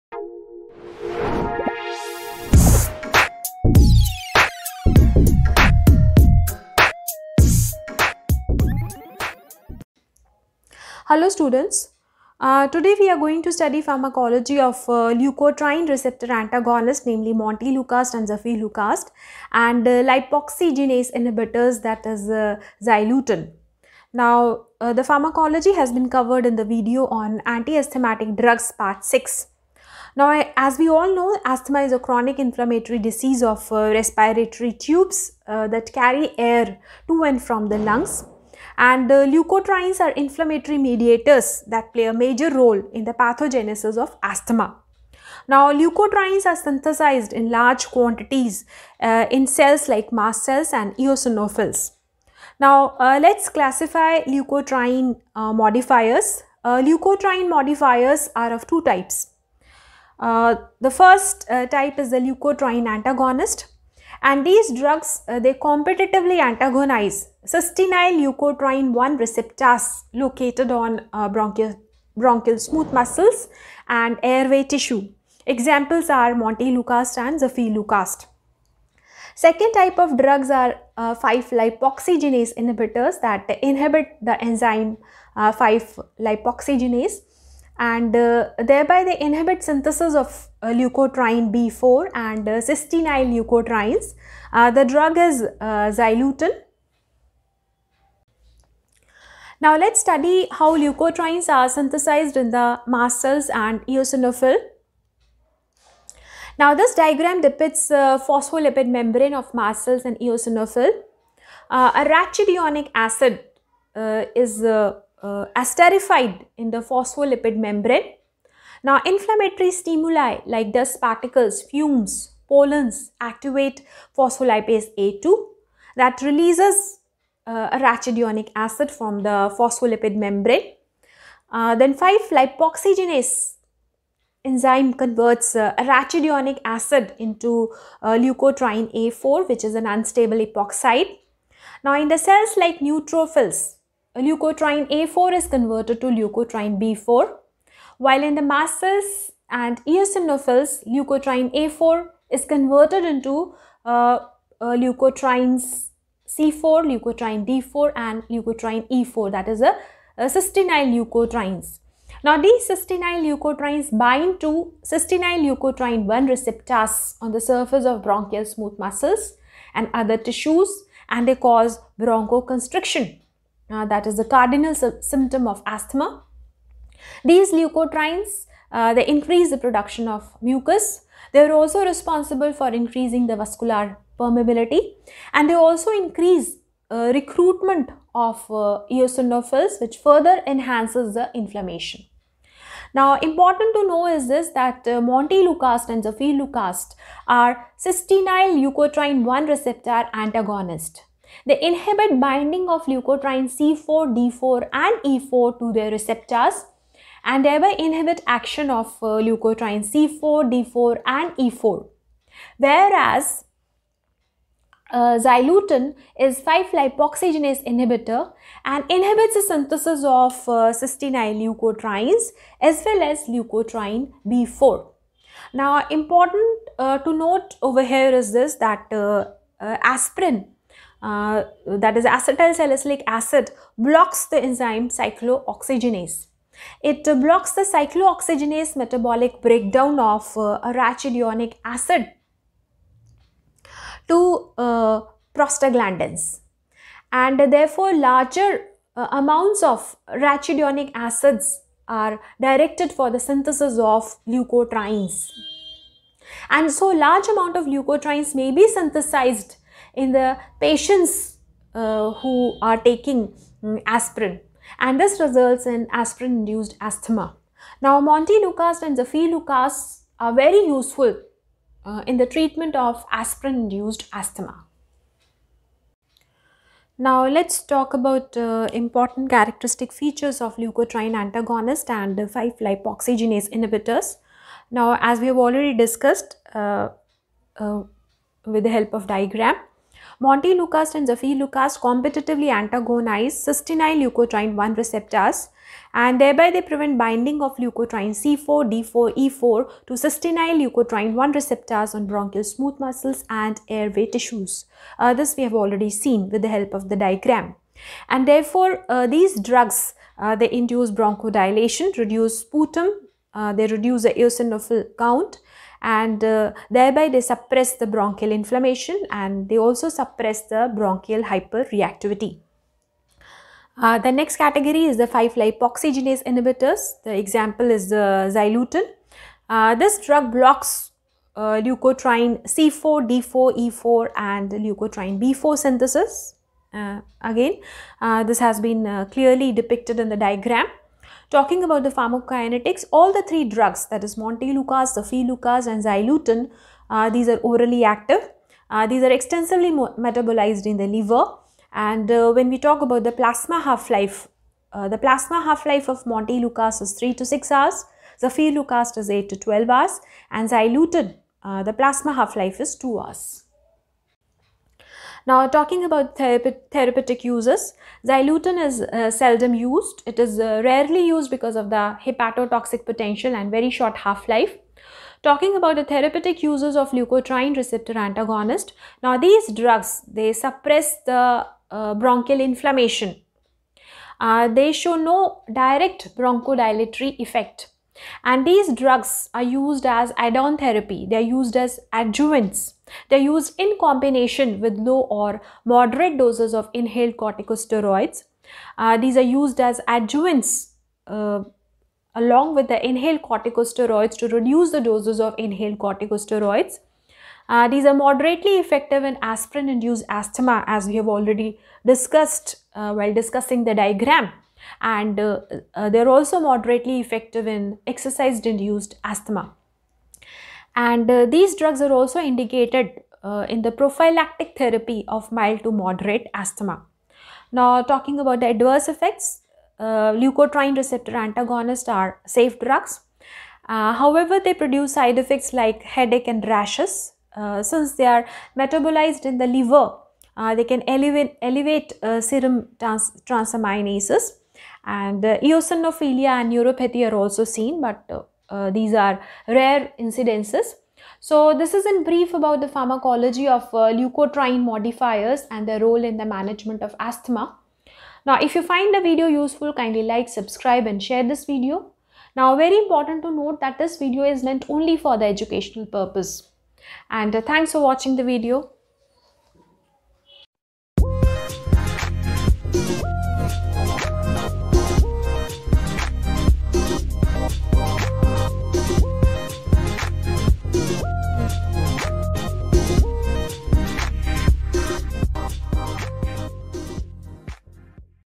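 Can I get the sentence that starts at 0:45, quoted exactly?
Now, leukotrienes are synthesized in large quantities uh, in cells like mast cells and eosinophils.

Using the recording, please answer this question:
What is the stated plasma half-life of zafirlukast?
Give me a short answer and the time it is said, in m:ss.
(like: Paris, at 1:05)
8 to 12 hours, at 5:59.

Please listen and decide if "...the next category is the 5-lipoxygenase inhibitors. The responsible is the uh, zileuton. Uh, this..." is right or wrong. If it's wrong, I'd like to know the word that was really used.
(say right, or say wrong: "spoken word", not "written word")
wrong: "example", not "responsible".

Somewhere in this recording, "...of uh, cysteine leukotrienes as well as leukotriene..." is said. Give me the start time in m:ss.
3:40.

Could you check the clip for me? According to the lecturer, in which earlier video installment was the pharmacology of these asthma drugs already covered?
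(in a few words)
Anti-asthmatic drugs part 6.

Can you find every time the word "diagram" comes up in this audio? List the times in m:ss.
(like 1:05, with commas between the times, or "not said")
1:46, 4:49, 5:07, 5:40, 6:53.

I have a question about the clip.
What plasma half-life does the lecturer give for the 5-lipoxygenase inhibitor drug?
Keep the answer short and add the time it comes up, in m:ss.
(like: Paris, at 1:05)
2 hours, at 6:02.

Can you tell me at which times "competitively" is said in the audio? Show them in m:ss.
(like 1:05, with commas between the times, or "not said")
1:05, 4:51.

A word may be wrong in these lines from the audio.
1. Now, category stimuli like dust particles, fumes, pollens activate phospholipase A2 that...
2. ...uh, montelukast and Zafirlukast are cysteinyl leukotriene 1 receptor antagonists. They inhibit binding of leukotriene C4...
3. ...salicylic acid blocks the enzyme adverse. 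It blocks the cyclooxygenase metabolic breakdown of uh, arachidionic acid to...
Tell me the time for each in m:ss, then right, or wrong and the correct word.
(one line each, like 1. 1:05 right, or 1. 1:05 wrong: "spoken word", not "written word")
1. 1:58 wrong: "inflammatory", not "category"
2. 3:14 wrong: "Lucast", not "Zafirlukast"
3. 3:52 wrong: "cyclooxygenase", not "adverse".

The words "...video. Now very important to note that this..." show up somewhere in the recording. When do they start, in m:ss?
7:41.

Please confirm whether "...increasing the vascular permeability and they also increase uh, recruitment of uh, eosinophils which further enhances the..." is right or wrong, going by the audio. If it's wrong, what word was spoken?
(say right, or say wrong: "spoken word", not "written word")
right.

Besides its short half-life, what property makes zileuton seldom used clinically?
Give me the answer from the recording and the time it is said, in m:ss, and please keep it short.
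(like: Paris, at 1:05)
Hepatotoxic potential, at 6:12.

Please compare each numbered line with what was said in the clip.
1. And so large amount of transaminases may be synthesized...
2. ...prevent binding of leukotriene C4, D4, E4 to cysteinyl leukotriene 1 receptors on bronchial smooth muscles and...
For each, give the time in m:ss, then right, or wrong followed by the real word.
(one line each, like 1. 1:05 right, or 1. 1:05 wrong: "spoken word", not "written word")
1. 4:16 wrong: "leukotrienes", not "transaminases"
2. 4:56 right.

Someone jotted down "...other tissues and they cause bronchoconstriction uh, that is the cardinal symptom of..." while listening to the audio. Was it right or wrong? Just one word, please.
right.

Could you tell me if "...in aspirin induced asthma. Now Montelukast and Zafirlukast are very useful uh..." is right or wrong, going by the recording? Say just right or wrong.
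right.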